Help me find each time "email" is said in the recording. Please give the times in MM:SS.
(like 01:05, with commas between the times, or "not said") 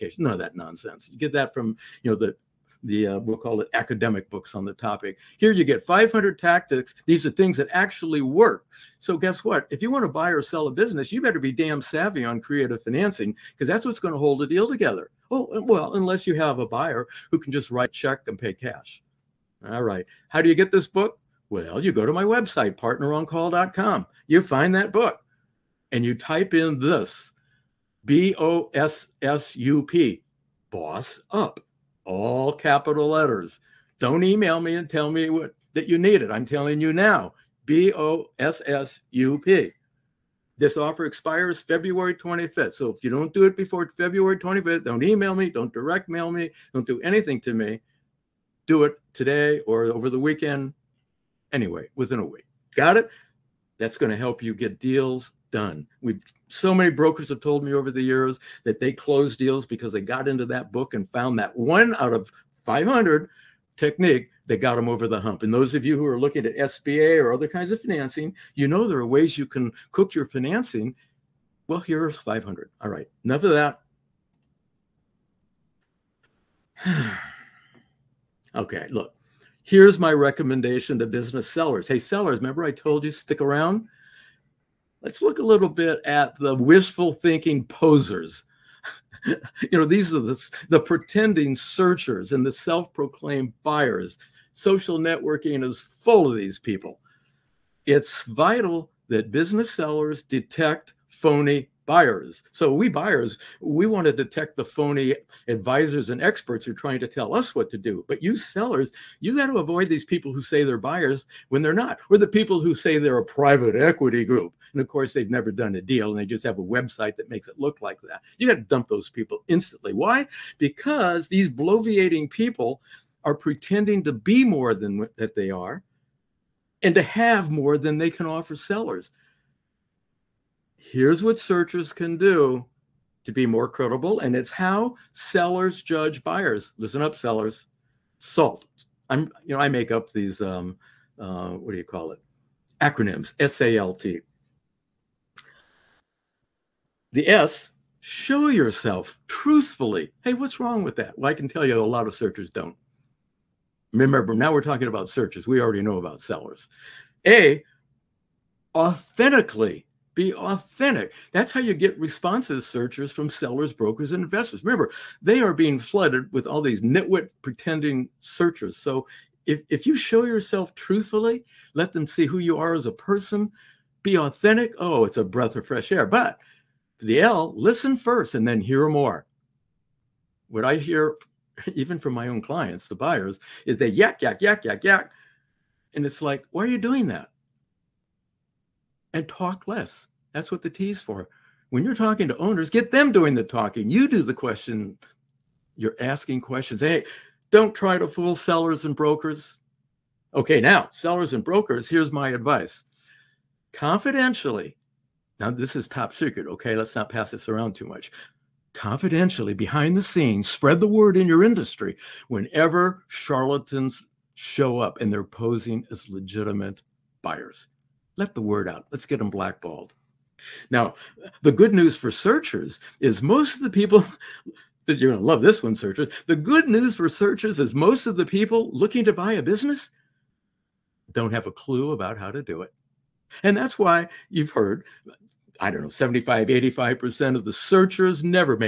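00:34, 00:45.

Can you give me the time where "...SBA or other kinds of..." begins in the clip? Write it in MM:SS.
01:06.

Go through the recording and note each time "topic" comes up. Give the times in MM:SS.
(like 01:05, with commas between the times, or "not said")
00:04.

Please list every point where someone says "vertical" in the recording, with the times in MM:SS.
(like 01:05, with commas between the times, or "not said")
not said.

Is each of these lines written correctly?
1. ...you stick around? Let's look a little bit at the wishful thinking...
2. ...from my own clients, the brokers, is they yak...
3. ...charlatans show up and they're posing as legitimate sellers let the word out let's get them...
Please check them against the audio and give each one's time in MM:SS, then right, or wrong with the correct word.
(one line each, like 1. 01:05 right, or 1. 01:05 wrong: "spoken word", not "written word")
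1. 01:23 right
2. 03:01 wrong: "buyers", not "brokers"
3. 03:33 wrong: "buyers", not "sellers".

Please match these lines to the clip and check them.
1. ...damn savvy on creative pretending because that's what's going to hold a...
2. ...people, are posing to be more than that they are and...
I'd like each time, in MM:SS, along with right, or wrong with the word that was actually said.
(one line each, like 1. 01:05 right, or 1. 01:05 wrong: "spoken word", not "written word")
1. 00:11 wrong: "financing", not "pretending"
2. 02:02 wrong: "pretending", not "posing".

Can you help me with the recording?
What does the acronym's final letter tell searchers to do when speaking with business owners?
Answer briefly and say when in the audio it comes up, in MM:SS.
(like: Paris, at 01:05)
Talk less, at 03:09.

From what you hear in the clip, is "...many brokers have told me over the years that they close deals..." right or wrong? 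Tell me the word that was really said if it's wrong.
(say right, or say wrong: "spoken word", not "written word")
right.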